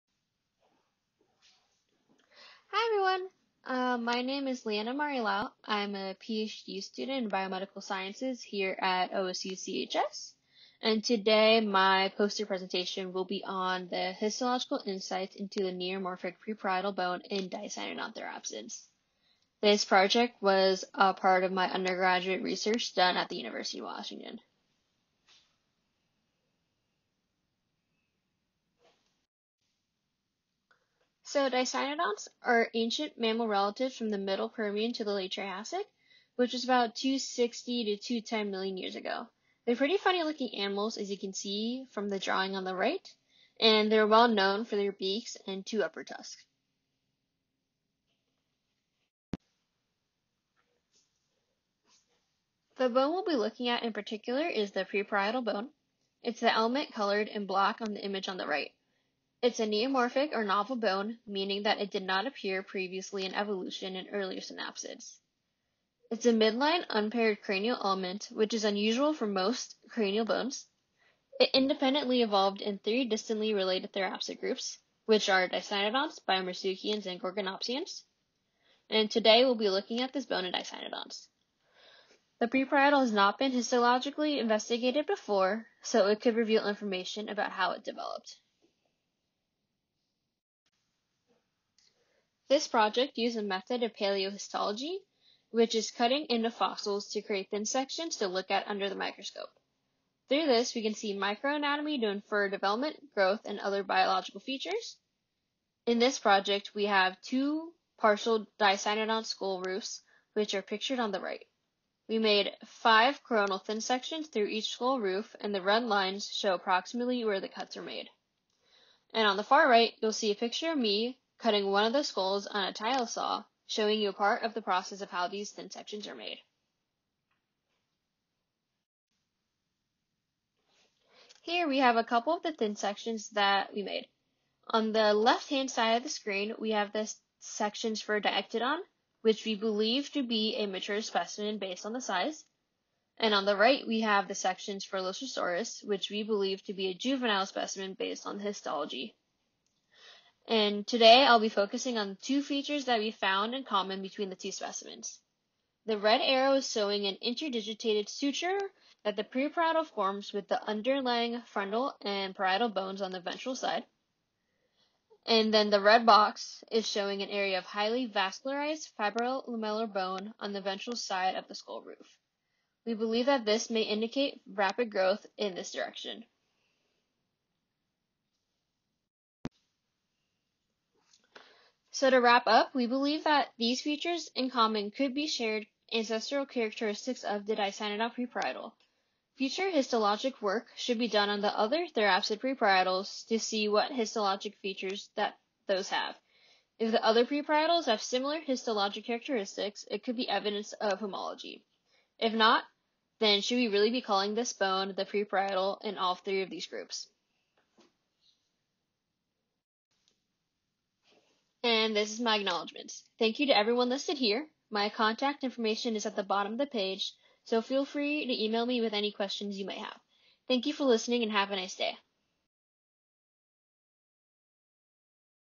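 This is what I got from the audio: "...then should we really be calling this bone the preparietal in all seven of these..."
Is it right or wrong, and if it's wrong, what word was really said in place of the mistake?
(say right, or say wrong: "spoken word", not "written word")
wrong: "three", not "seven".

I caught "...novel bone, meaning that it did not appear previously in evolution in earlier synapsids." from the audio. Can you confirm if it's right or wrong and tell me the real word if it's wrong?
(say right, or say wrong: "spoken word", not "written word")
right.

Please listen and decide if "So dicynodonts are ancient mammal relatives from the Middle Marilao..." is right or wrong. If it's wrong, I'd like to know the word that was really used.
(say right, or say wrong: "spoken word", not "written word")
wrong: "Permian", not "Marilao".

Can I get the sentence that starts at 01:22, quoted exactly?
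The preparietal has not been histologically investigated before, so it could reveal information about how it developed.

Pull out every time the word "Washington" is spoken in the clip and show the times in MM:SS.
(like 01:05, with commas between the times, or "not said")
00:23.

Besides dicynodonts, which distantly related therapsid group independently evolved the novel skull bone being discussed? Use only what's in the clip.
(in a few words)
Biarmosuchians.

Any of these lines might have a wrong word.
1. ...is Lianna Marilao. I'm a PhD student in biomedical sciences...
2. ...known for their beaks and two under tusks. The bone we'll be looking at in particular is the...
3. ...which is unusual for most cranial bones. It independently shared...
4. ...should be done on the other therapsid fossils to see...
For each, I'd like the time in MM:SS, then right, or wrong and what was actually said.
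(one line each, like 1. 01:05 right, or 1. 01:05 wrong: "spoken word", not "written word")
1. 00:04 right
2. 00:44 wrong: "upper", not "under"
3. 01:08 wrong: "evolved", not "shared"
4. 03:10 wrong: "preparietals", not "fossils".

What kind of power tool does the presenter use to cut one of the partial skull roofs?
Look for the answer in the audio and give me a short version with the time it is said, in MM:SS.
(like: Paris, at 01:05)
Tile saw, at 02:02.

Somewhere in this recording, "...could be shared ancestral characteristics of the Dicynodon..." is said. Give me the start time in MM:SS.
03:04.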